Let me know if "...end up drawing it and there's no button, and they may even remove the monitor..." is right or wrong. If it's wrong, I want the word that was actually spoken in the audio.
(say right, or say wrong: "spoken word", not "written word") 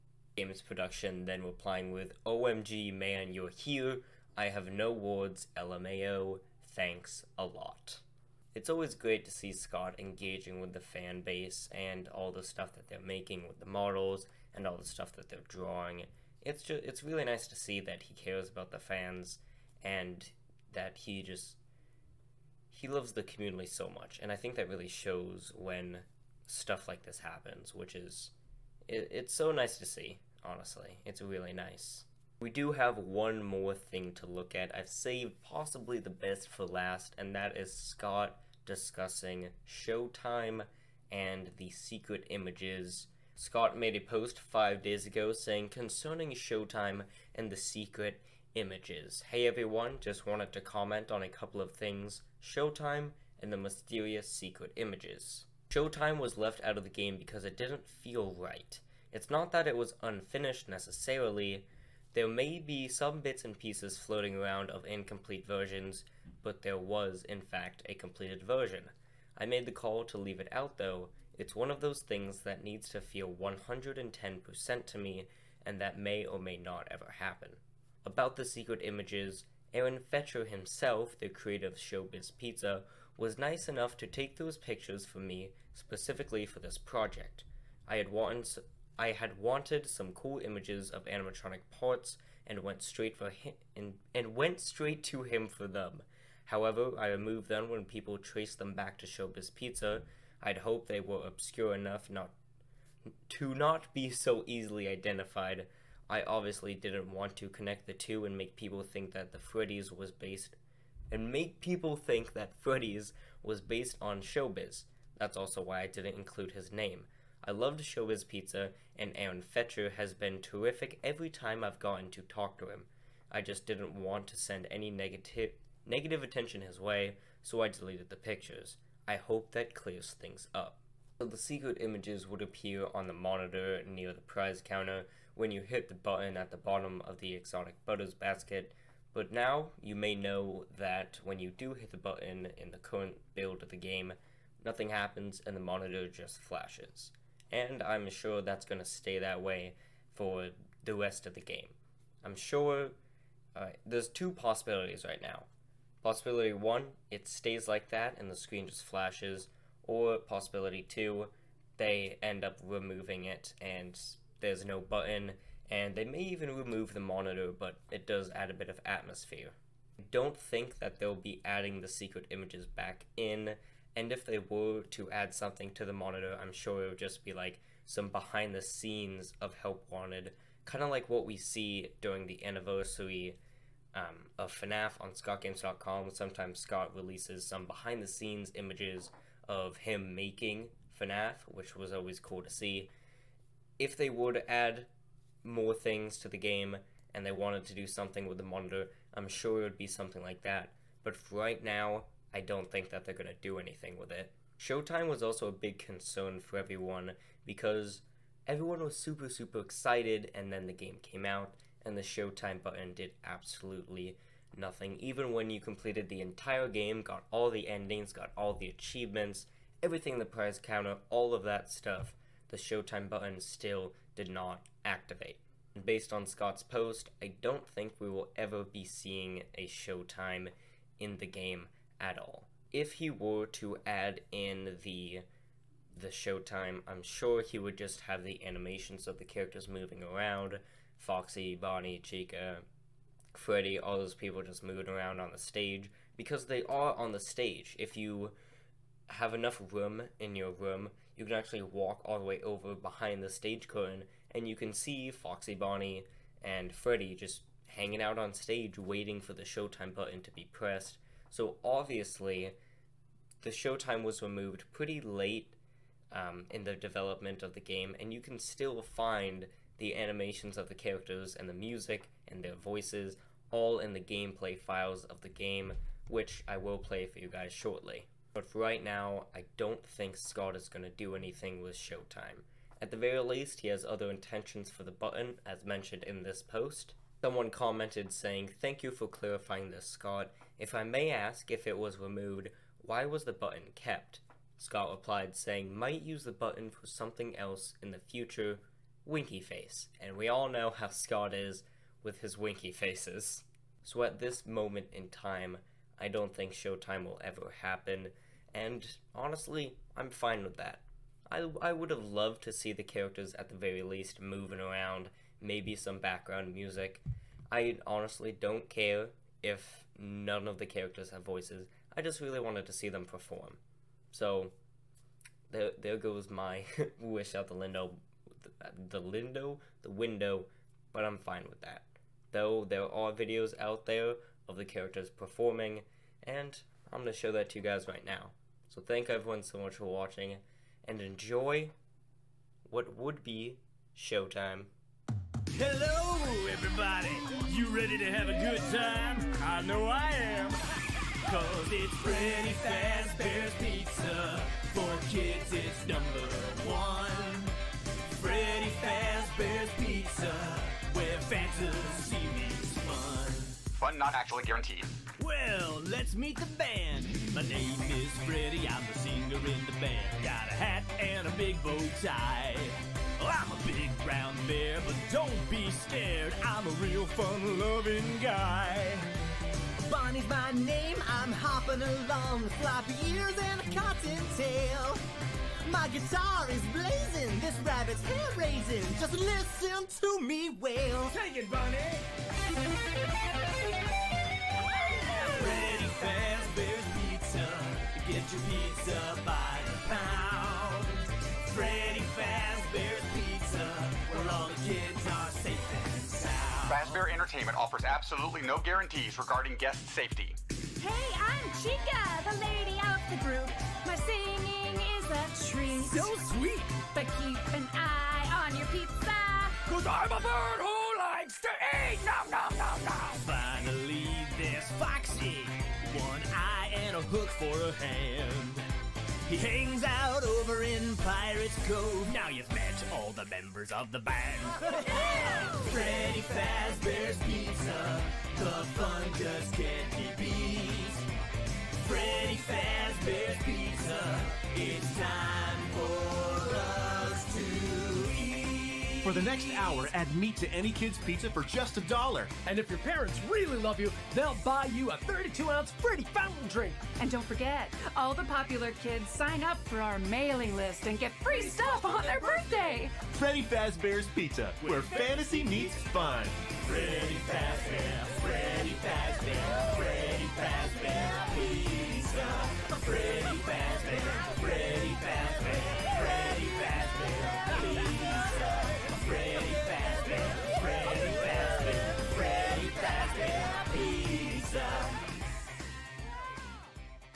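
wrong: "removing", not "drawing".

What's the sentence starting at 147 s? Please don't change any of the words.
And I'm sure that's going to stay that way for the rest of the game.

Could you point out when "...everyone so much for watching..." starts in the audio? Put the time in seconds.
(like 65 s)
339 s.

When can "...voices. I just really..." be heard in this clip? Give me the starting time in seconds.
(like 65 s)
321 s.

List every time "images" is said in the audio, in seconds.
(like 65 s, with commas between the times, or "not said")
42 s, 48 s, 54 s, 78 s, 90 s, 131 s, 172 s, 188 s.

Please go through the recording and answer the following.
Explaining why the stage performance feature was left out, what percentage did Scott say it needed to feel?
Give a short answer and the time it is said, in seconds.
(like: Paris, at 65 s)
110%, at 73 s.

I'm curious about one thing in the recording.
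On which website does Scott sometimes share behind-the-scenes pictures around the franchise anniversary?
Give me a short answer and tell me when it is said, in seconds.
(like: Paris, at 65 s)
ScottGames.com, at 185 s.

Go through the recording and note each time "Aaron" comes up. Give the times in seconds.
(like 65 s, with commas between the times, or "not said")
79 s, 119 s.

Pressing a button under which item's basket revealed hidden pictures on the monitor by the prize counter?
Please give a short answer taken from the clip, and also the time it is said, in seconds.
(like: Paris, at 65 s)
exotic butters, at 137 s.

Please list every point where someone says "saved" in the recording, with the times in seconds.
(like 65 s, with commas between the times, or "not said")
34 s.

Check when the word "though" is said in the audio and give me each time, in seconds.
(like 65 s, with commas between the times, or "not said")
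70 s, 332 s.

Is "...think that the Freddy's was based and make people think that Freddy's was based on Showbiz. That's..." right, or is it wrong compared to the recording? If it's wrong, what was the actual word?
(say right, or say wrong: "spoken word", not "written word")
right.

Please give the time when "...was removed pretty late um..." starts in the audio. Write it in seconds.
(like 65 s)
264 s.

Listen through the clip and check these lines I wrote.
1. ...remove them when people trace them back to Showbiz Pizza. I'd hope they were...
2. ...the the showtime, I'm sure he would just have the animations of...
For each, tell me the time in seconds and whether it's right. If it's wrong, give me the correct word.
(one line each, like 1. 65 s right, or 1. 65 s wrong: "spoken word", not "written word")
1. 97 s right
2. 234 s right.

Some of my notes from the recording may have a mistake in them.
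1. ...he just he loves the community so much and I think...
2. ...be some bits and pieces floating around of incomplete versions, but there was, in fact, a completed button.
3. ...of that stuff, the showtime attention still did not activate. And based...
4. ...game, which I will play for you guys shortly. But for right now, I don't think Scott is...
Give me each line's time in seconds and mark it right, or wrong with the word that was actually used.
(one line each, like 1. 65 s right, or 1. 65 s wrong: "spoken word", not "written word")
1. 20 s right
2. 62 s wrong: "version", not "button"
3. 221 s wrong: "button", not "attention"
4. 275 s right.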